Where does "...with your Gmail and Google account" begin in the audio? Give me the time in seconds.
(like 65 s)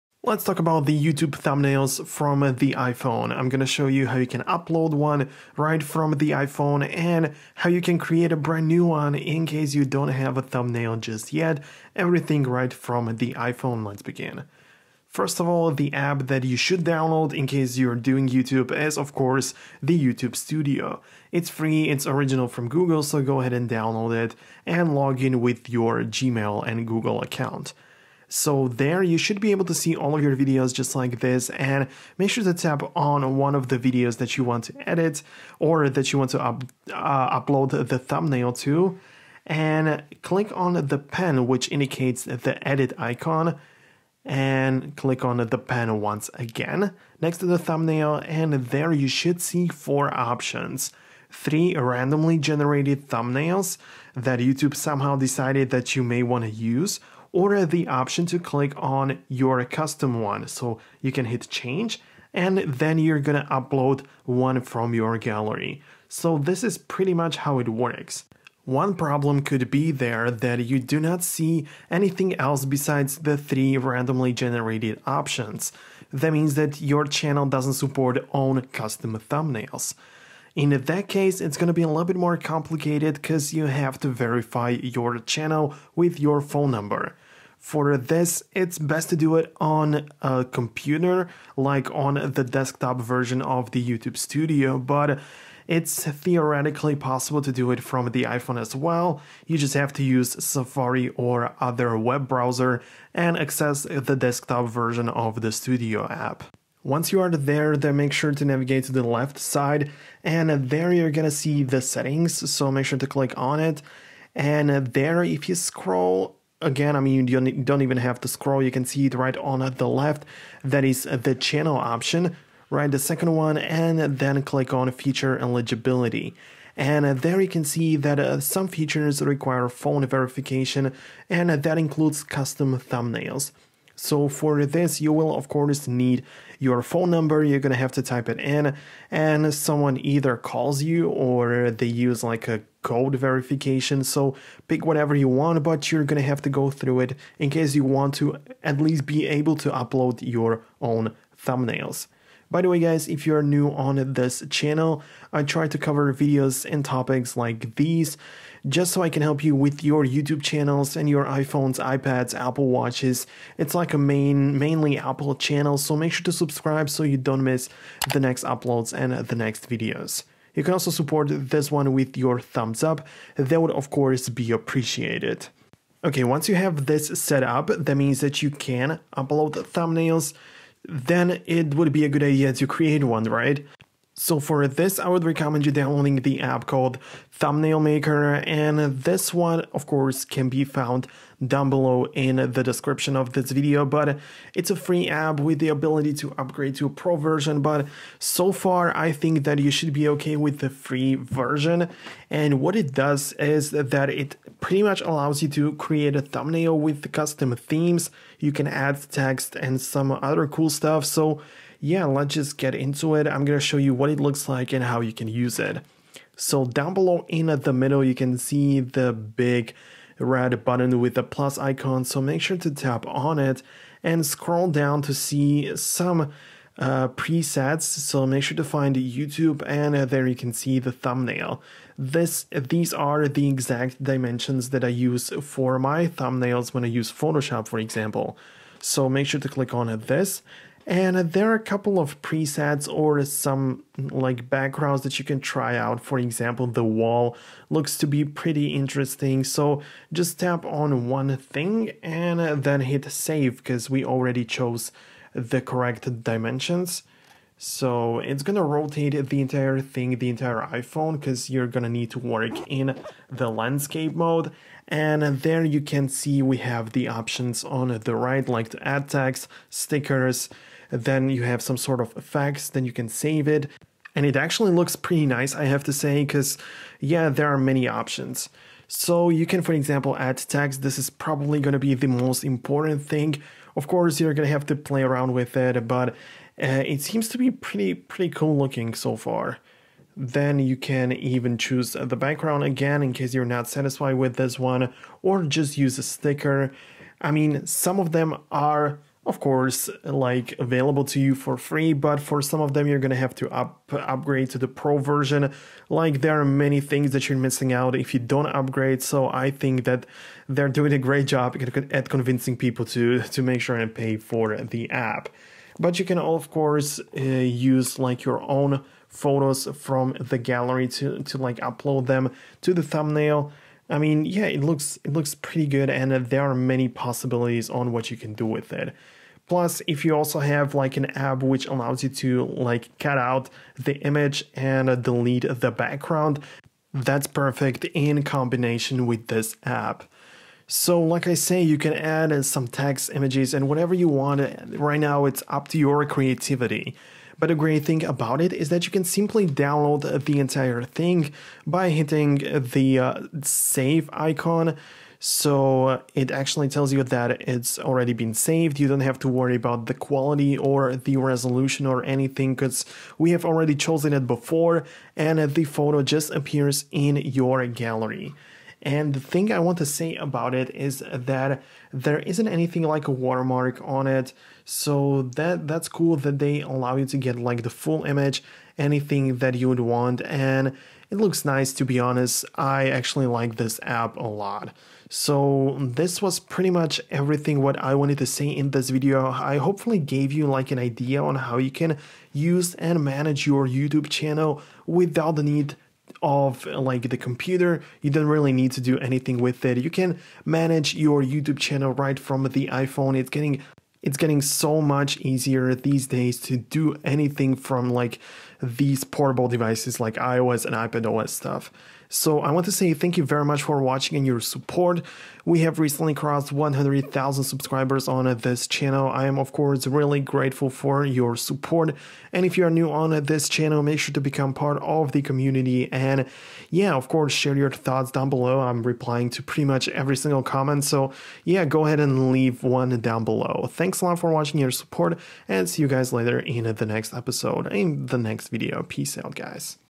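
25 s.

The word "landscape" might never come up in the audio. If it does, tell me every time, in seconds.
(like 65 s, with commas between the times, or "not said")
263 s.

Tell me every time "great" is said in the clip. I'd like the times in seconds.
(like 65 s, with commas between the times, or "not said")
310 s, 347 s.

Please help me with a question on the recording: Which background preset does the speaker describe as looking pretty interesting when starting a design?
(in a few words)
The wall.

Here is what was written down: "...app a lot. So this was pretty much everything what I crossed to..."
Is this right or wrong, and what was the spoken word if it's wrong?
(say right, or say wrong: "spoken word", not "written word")
wrong: "wanted", not "crossed".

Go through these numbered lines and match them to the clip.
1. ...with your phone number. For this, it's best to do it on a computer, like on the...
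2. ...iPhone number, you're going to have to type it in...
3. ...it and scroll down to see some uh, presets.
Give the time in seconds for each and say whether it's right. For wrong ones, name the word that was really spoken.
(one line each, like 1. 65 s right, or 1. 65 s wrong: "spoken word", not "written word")
1. 85 s right
2. 136 s wrong: "phone", not "iPhone"
3. 223 s right.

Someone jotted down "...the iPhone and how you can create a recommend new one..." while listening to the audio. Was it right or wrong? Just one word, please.
wrong.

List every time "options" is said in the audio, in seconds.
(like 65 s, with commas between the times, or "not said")
50 s, 57 s, 75 s, 121 s, 267 s, 277 s.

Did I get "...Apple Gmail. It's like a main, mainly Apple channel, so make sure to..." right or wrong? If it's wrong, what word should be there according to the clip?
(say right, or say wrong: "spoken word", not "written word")
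wrong: "Watches", not "Gmail".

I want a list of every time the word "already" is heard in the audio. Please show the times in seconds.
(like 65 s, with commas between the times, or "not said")
254 s, 357 s, 363 s.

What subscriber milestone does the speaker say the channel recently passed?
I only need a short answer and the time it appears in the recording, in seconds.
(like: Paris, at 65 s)
100,000, at 416 s.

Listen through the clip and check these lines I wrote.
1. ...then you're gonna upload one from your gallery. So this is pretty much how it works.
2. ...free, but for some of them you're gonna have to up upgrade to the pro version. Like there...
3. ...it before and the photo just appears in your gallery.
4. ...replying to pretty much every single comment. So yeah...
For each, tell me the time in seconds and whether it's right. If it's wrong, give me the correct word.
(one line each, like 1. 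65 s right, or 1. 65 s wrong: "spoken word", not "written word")
1. 62 s right
2. 301 s right
3. 364 s right
4. 428 s right.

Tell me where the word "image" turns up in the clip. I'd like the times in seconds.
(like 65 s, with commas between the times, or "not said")
334 s, 343 s, 378 s.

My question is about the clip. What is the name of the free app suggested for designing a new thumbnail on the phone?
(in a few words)
Thumbnail Maker.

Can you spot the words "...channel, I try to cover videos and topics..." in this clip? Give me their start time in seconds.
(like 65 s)
154 s.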